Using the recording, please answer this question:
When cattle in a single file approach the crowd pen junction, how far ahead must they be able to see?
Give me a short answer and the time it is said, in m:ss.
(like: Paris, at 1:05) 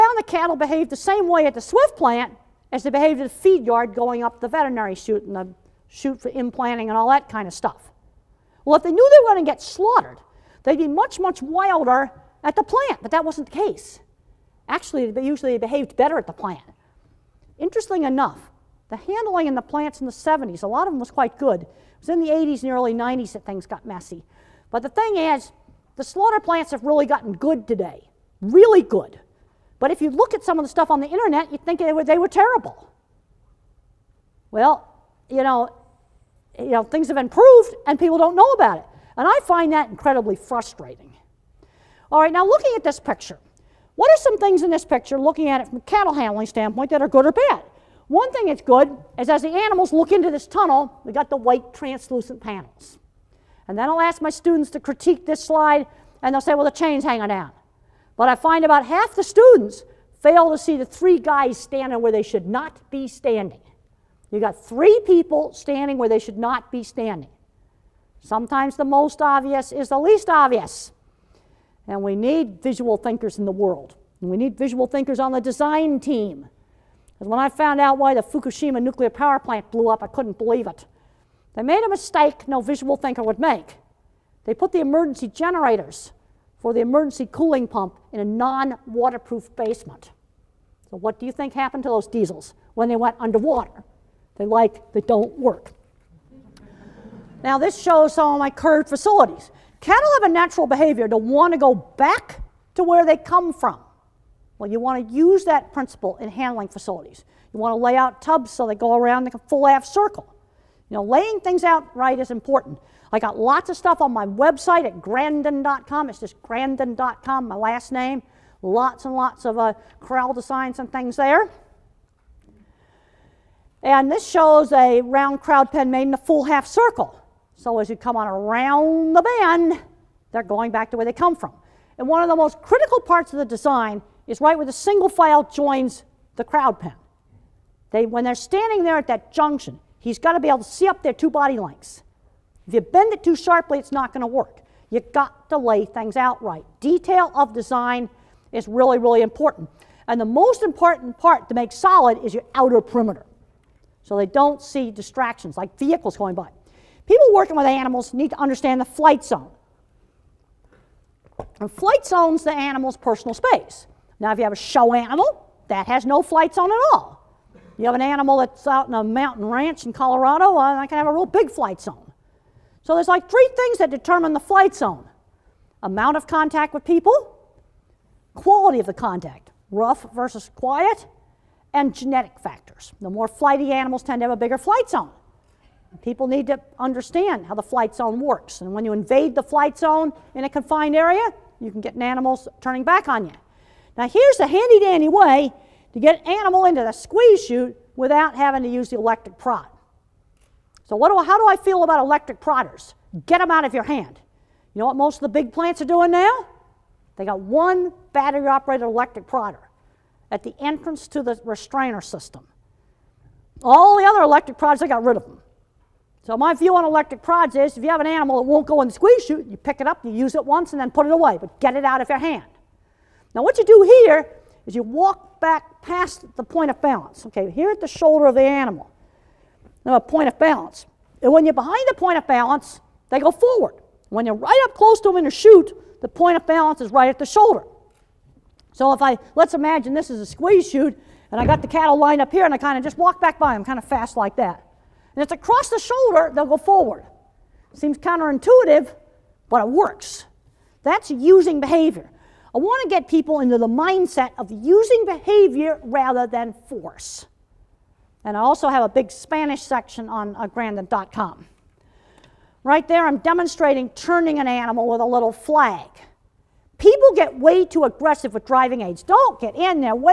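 2 body lengths, at 2:21.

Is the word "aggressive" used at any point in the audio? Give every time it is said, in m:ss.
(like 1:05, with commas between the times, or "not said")
4:27.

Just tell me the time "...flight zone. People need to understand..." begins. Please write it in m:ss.
3:04.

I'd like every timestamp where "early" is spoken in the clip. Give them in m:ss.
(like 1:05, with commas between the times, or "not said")
0:22.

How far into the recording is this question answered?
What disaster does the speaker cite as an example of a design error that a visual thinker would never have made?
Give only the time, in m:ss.
1:18.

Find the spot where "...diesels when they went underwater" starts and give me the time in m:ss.
1:32.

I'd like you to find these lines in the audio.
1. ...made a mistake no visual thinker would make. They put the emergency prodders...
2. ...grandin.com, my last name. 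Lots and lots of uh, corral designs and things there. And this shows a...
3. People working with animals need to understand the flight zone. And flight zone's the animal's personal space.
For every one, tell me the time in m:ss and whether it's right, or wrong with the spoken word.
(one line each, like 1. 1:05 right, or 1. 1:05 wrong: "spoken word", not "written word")
1. 1:21 wrong: "generators", not "prodders"
2. 1:56 right
3. 2:37 right.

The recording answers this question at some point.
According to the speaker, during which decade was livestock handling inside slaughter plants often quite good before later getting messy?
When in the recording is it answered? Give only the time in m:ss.
0:20.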